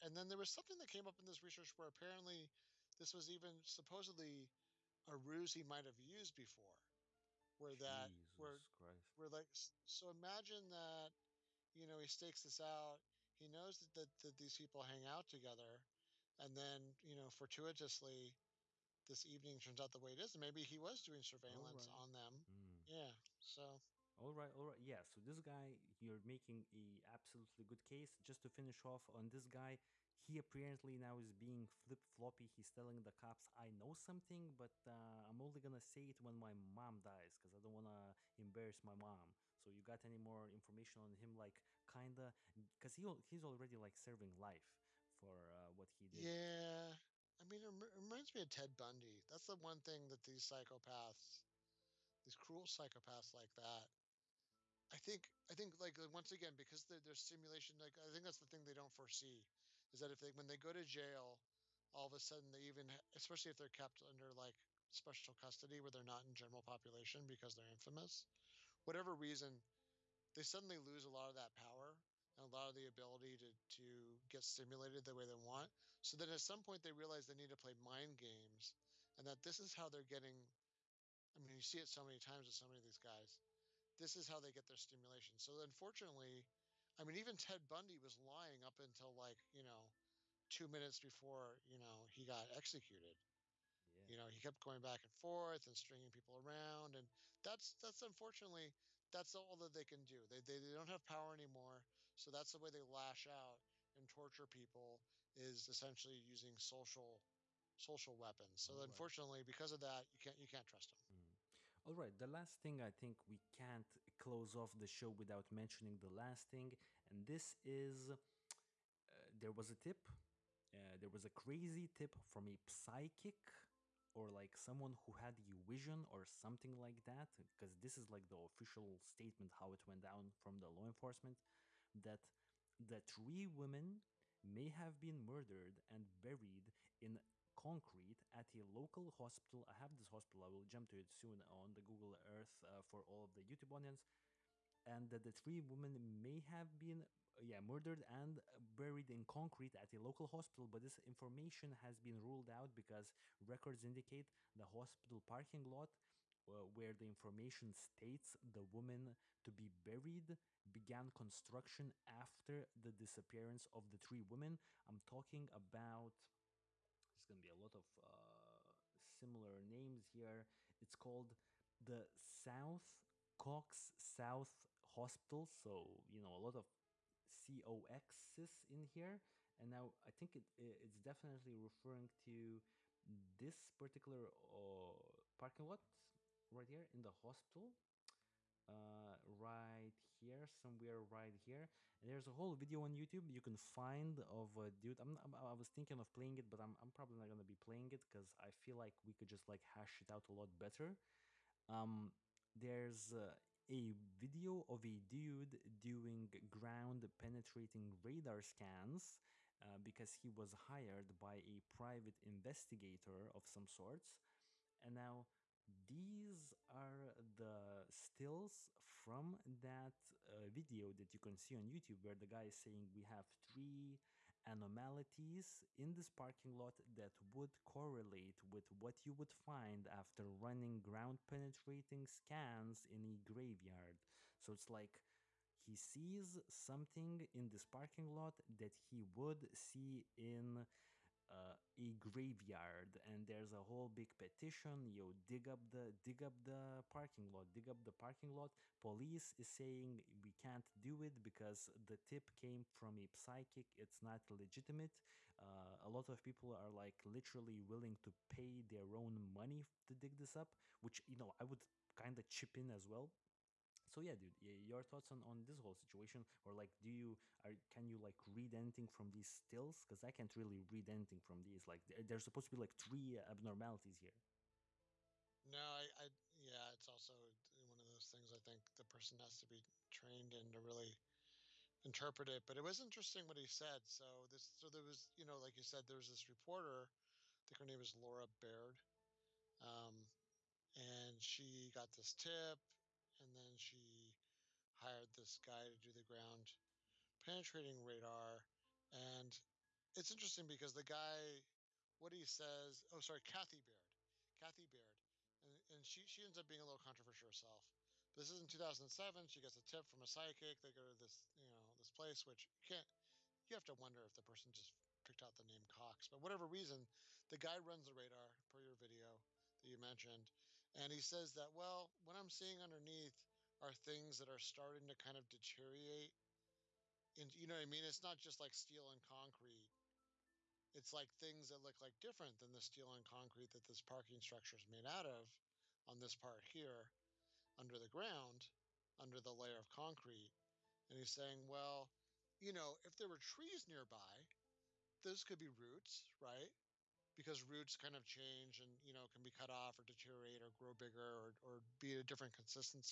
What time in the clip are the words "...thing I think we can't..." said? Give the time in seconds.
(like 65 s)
112 s.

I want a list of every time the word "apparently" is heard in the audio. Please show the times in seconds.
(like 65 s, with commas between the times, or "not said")
1 s, 30 s.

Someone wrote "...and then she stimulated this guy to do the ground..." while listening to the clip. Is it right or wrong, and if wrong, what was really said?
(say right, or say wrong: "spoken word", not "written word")
wrong: "hired", not "stimulated".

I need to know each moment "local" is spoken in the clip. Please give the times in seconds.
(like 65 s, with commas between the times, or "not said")
138 s, 150 s.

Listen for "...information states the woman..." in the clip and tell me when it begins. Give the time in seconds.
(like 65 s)
157 s.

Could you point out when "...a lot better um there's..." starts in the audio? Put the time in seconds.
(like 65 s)
200 s.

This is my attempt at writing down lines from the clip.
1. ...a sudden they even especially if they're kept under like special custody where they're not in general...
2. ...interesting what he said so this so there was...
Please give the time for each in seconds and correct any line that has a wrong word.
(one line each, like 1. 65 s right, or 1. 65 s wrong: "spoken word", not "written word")
1. 62 s right
2. 282 s right.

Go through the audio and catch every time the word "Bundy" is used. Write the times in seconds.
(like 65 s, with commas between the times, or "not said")
48 s, 87 s.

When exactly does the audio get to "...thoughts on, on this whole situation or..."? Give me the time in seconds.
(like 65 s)
264 s.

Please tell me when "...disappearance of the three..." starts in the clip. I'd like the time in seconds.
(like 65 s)
162 s.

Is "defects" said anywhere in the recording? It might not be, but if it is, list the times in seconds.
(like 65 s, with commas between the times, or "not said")
not said.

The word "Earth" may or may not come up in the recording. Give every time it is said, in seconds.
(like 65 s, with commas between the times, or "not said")
142 s.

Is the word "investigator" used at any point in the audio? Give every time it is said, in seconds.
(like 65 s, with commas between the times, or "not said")
212 s.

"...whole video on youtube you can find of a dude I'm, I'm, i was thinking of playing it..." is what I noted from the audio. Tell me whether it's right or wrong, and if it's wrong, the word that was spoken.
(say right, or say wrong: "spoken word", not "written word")
right.